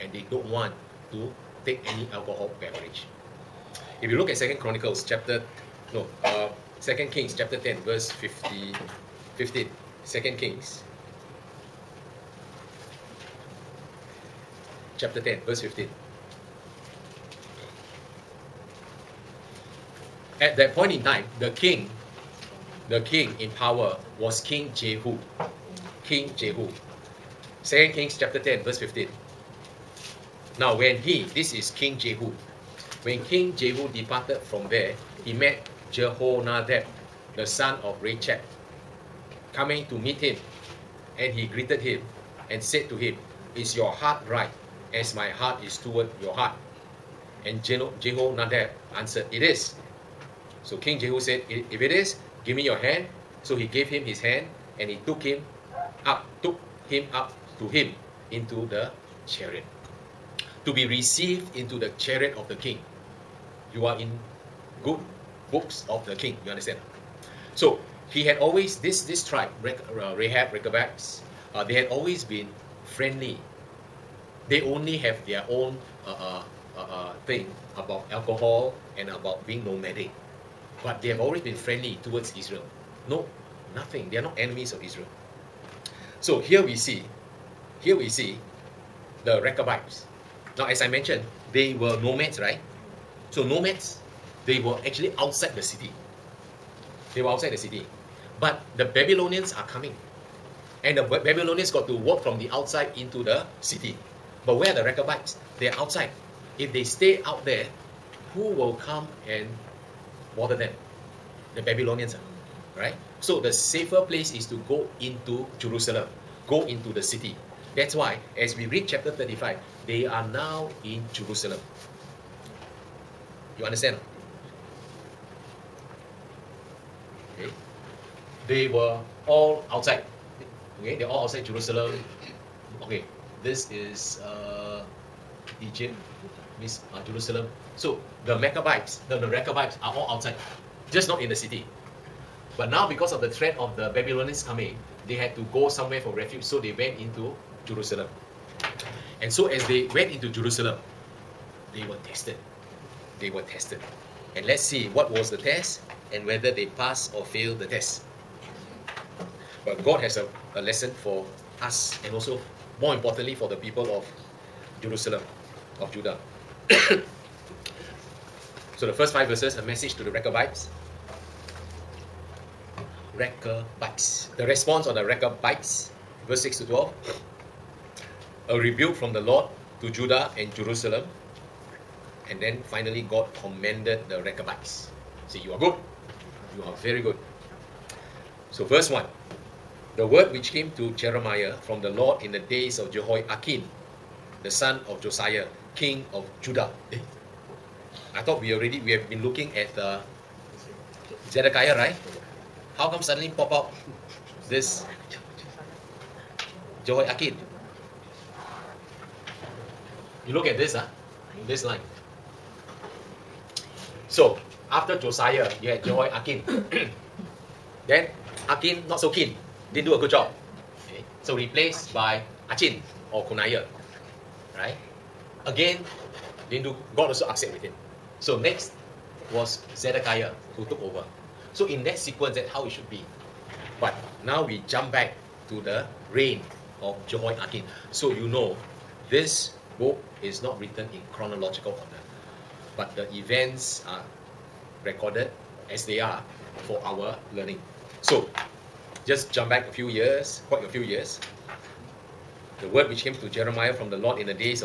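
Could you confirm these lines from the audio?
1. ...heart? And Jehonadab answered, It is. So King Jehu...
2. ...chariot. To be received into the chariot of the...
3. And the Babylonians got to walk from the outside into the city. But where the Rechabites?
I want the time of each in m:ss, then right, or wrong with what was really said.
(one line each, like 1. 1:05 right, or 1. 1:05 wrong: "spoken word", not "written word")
1. 0:46 right
2. 0:59 right
3. 1:40 right.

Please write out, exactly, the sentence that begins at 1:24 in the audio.
They are not enemies of Israel.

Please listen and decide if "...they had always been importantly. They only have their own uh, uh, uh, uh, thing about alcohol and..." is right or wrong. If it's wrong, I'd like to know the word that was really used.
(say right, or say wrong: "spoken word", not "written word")
wrong: "friendly", not "importantly".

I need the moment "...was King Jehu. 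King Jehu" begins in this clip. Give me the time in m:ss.
0:24.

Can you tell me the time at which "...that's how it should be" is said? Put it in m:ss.
3:52.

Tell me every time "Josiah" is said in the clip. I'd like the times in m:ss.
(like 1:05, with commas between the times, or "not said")
3:14, 3:34.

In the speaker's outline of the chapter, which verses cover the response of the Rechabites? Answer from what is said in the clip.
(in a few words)
6 to 12.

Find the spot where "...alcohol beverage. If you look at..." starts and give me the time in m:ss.
0:02.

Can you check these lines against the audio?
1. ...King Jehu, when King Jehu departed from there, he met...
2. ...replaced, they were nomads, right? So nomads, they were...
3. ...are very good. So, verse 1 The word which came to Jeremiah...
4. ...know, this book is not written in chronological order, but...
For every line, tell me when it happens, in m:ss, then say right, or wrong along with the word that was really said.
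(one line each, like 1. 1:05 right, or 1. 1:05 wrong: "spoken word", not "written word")
1. 0:31 right
2. 1:30 wrong: "mentioned", not "replaced"
3. 3:06 right
4. 3:58 right.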